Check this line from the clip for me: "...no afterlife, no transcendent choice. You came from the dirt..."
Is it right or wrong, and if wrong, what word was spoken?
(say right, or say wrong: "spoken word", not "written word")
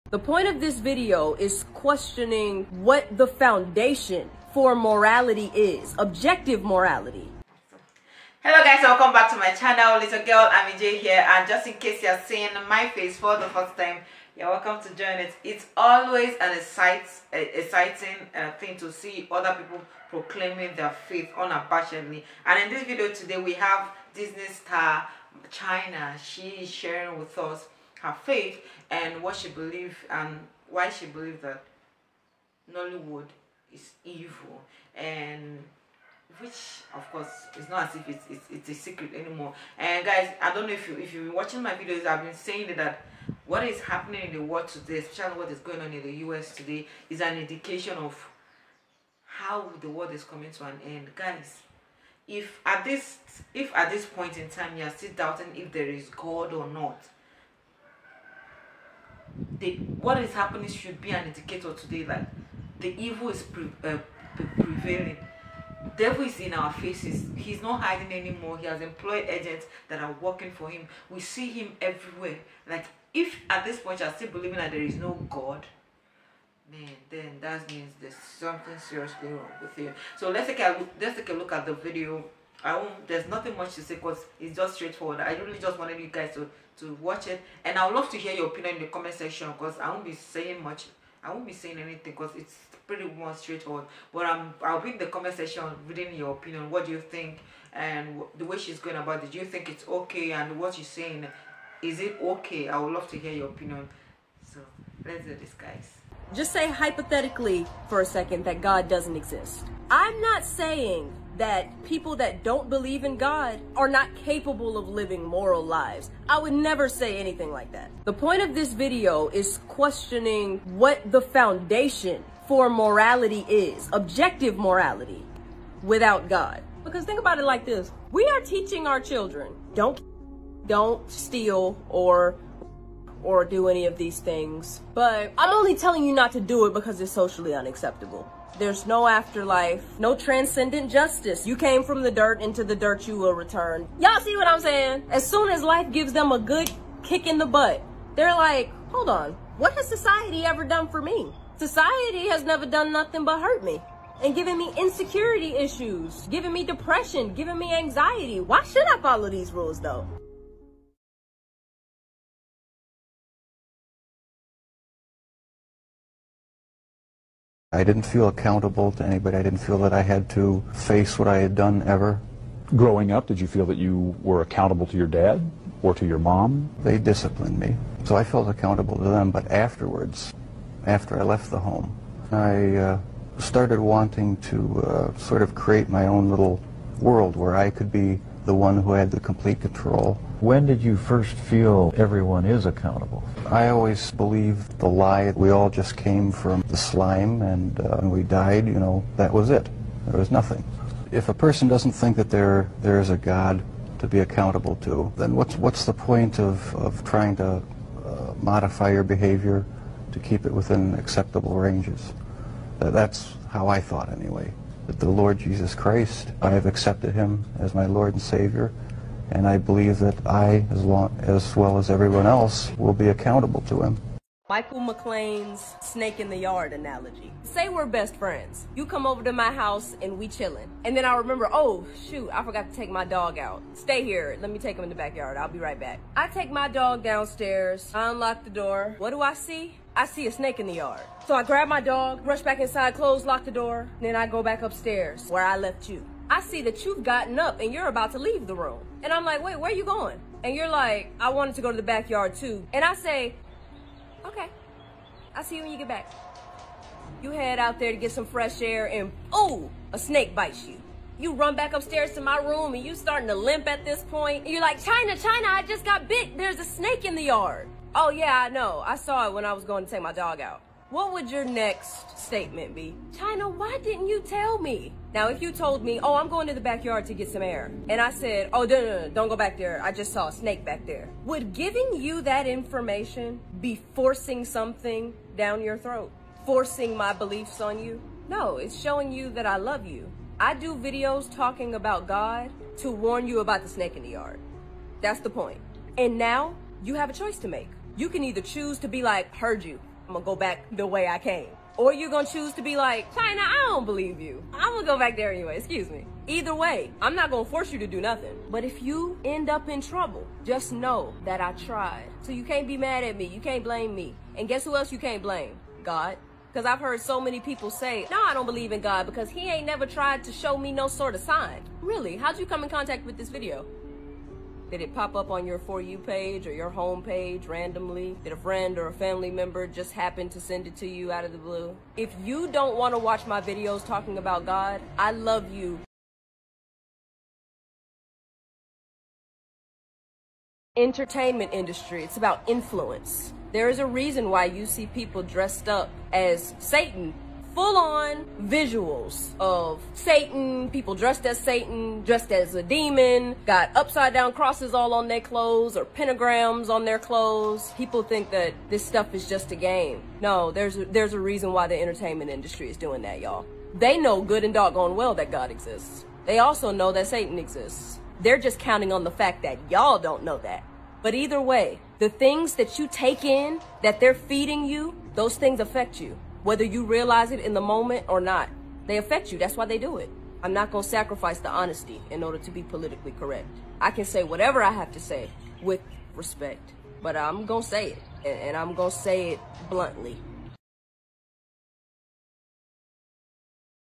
wrong: "justice", not "choice".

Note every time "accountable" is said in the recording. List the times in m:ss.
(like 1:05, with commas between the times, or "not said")
2:48, 2:54, 2:58, 3:12, 3:24, 3:43.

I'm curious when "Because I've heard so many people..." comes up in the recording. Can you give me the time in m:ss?
5:16.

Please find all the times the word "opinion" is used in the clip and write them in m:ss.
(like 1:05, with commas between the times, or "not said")
1:28, 1:36, 1:43.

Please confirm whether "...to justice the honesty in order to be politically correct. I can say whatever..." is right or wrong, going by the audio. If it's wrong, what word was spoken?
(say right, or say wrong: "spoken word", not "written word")
wrong: "sacrifice", not "justice".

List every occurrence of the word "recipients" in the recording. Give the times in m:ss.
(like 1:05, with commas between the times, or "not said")
not said.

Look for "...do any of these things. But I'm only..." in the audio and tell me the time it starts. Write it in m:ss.
2:13.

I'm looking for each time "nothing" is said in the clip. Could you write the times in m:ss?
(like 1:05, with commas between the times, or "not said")
1:23, 2:32, 3:20, 5:08.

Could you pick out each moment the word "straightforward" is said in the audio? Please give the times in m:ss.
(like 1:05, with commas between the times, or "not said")
1:24, 1:33.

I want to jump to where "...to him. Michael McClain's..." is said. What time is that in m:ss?
3:43.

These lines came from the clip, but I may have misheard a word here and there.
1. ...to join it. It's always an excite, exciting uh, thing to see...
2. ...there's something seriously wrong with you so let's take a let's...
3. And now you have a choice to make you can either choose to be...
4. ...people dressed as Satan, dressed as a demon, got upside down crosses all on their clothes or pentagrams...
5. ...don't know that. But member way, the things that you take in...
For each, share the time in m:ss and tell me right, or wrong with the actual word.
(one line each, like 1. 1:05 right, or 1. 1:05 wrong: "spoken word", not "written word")
1. 0:14 right
2. 1:18 right
3. 4:55 right
4. 5:50 right
5. 6:09 wrong: "either", not "member".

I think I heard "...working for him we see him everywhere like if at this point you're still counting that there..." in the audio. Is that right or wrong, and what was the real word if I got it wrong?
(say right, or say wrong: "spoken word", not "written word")
wrong: "believing", not "counting".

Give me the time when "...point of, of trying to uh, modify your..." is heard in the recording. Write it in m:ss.
3:25.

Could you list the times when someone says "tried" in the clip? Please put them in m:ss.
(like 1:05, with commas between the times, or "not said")
5:11, 5:19.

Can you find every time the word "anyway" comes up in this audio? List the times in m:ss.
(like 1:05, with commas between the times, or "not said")
3:34, 5:05.